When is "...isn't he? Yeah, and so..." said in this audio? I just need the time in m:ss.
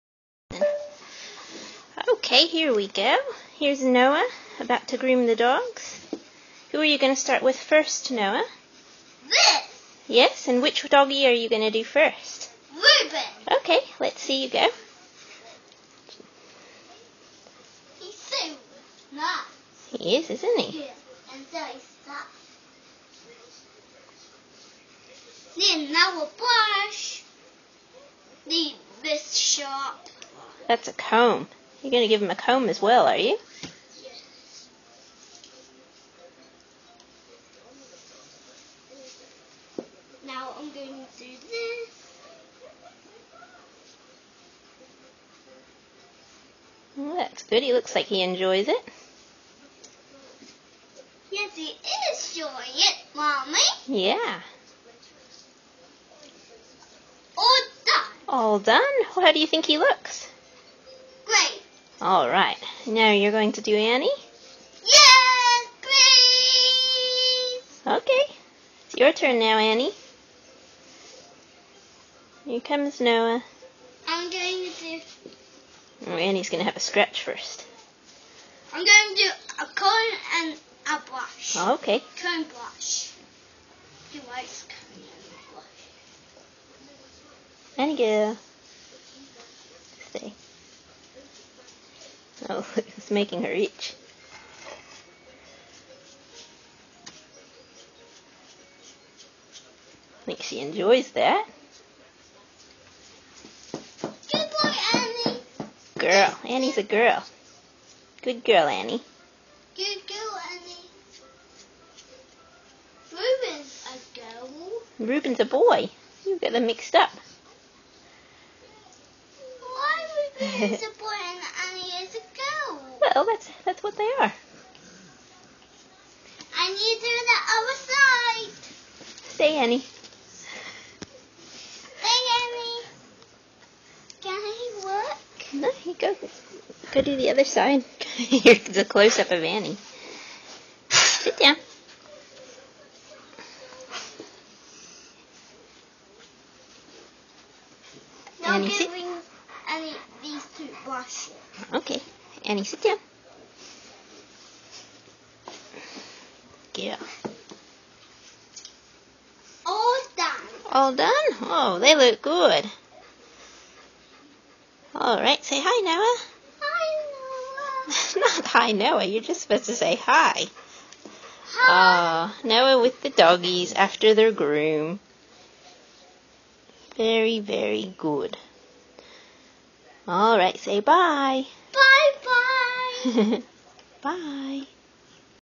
0:20.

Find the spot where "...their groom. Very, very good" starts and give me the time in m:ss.
2:54.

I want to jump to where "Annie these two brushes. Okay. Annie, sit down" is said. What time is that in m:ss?
2:29.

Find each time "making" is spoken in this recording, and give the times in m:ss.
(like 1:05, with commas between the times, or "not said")
1:33.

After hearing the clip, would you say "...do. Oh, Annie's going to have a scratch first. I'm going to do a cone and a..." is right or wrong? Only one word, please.
right.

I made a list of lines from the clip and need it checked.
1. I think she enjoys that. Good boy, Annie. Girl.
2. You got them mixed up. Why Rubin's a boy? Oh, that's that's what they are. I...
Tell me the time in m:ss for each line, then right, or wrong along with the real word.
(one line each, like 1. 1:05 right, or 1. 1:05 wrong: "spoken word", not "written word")
1. 1:40 right
2. 1:56 right.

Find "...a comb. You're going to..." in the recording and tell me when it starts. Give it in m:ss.
0:30.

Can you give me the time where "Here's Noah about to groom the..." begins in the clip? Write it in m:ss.
0:03.